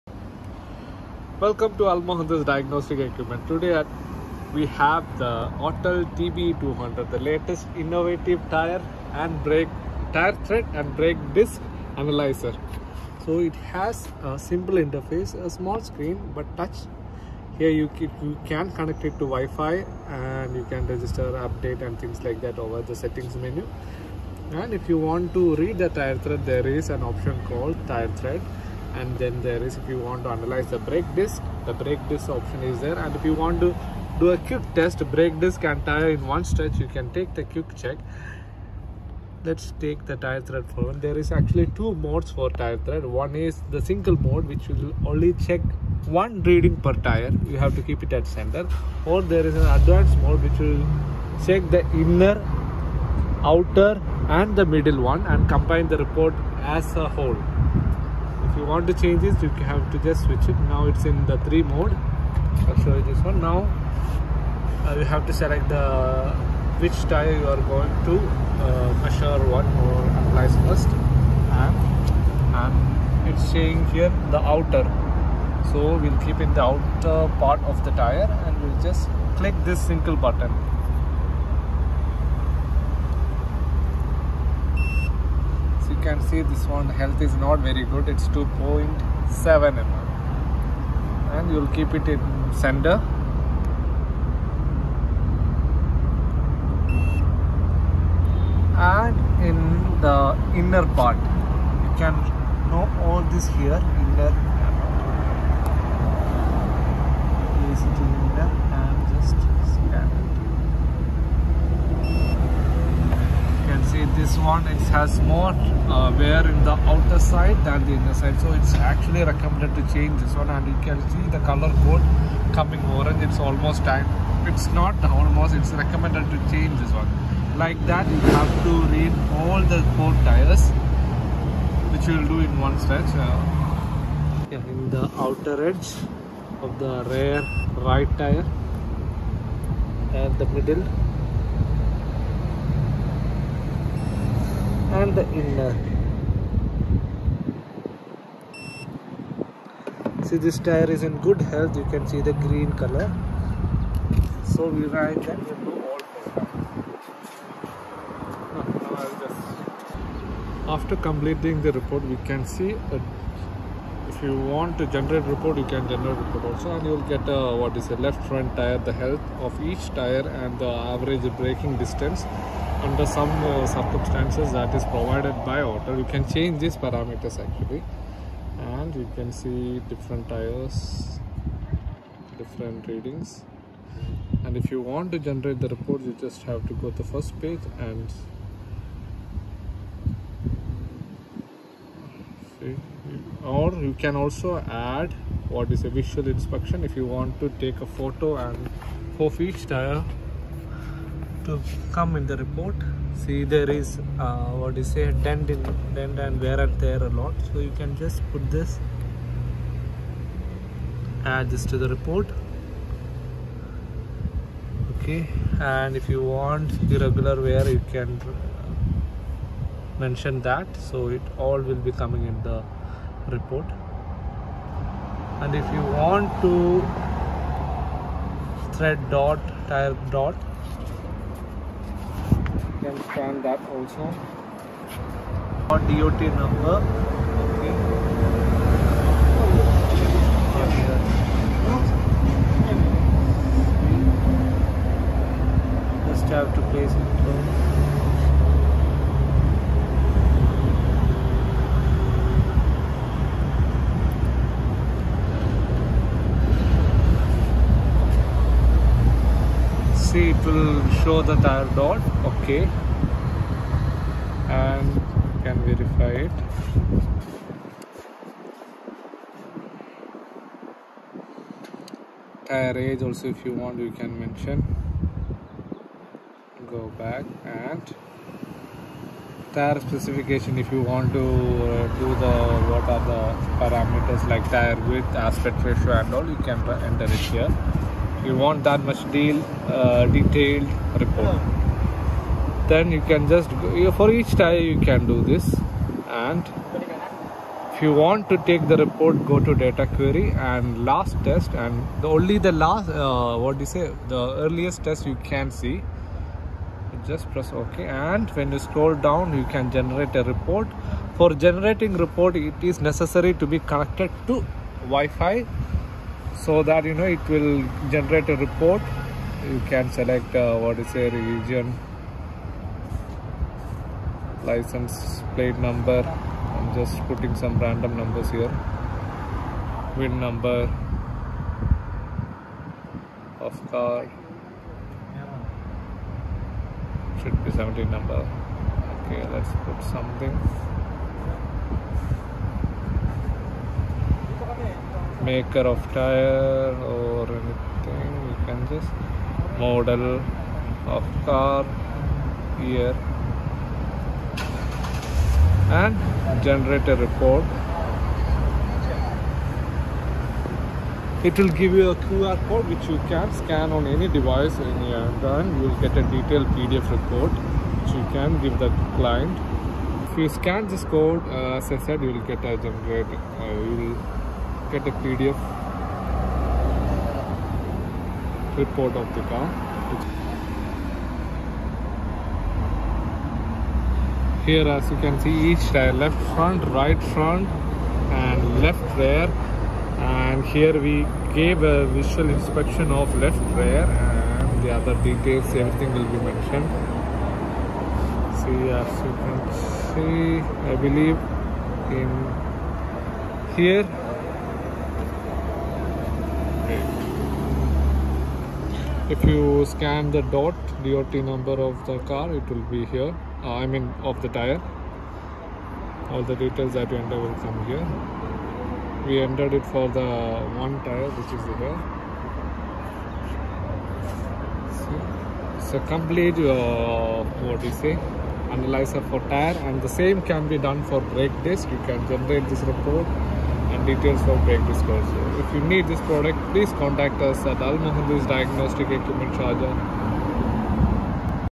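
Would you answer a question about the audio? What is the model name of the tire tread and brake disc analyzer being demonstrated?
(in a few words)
Autel TB200.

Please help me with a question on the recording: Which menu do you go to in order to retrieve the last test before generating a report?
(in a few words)
data query.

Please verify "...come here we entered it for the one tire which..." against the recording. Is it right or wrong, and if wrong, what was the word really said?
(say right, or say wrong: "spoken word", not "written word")
right.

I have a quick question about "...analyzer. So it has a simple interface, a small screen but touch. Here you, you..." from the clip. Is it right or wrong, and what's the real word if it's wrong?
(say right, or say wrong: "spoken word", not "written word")
right.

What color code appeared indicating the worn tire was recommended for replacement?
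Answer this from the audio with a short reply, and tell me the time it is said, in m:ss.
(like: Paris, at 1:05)
orange, at 2:02.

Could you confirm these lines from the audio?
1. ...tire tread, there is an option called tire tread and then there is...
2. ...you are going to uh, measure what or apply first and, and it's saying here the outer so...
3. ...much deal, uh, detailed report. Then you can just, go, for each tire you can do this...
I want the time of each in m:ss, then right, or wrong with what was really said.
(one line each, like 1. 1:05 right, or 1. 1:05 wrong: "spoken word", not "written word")
1. 0:25 right
2. 1:07 right
3. 4:48 right.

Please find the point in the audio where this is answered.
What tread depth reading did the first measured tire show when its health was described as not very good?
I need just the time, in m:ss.
1:28.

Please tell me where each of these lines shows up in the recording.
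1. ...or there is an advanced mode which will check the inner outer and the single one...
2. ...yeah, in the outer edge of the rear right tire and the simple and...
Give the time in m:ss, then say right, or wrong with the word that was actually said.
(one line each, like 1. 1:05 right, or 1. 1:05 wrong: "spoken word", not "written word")
1. 0:49 wrong: "middle", not "single"
2. 2:14 wrong: "middle", not "simple".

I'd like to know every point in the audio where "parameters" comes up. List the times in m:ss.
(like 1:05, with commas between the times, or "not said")
2:56, 4:43.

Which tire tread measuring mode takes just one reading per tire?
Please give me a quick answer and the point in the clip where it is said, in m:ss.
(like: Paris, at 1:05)
single mode, at 0:43.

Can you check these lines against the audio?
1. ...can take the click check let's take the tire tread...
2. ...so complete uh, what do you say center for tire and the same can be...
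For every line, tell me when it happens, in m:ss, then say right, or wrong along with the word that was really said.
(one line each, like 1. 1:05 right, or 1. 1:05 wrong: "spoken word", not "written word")
1. 0:36 wrong: "quick", not "click"
2. 7:05 wrong: "analyzer", not "center".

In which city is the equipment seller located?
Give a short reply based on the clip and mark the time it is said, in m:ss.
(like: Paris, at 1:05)
Sharjah, at 7:19.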